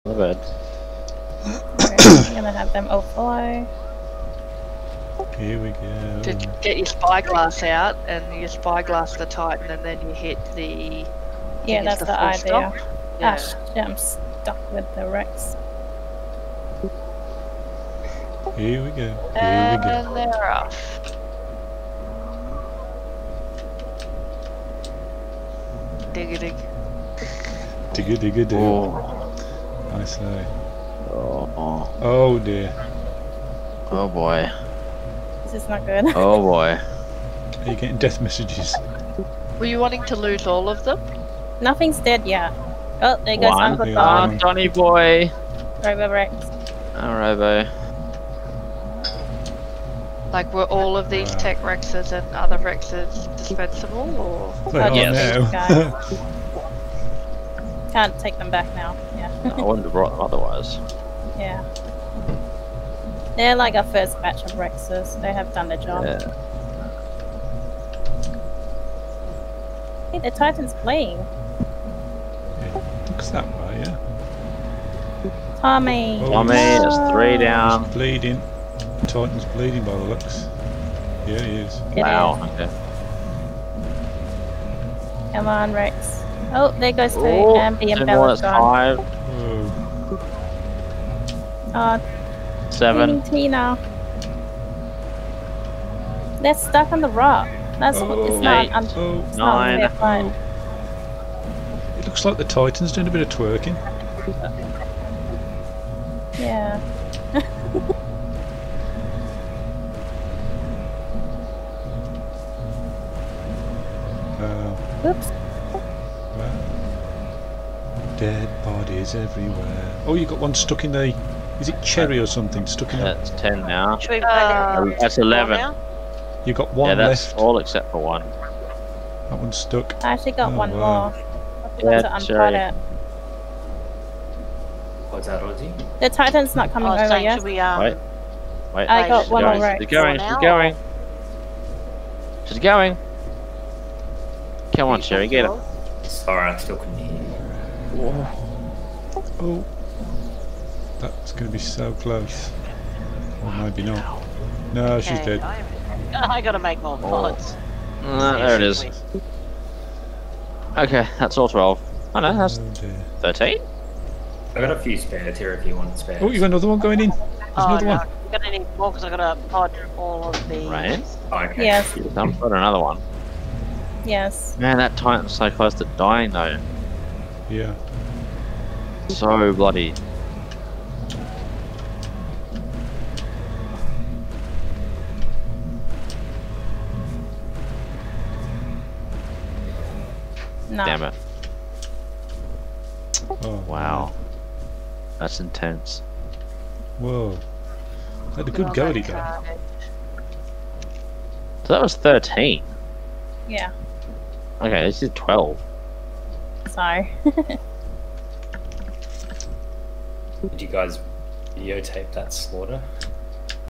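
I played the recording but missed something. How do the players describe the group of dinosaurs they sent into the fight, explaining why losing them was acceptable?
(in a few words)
first batch of rexes.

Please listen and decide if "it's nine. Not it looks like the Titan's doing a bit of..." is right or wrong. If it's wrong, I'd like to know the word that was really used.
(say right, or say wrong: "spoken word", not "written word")
right.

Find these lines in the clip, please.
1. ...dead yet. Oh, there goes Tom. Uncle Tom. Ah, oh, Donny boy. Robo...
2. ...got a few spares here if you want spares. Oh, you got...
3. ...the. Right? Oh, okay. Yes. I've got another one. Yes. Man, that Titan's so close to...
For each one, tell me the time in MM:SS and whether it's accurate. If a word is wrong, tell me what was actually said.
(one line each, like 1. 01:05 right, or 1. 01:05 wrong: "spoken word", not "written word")
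1. 00:41 wrong: "One", not "Tom"
2. 02:44 right
3. 02:50 right.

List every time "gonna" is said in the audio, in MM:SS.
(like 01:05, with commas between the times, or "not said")
00:02, 02:48.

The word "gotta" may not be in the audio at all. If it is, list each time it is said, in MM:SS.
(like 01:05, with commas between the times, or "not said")
02:36, 02:49.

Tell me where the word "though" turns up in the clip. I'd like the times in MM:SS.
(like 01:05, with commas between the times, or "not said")
02:56, 03:18.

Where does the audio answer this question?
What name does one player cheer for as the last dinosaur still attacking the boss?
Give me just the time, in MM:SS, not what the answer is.
02:25.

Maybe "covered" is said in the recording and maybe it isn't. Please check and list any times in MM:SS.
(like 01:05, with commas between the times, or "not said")
00:00.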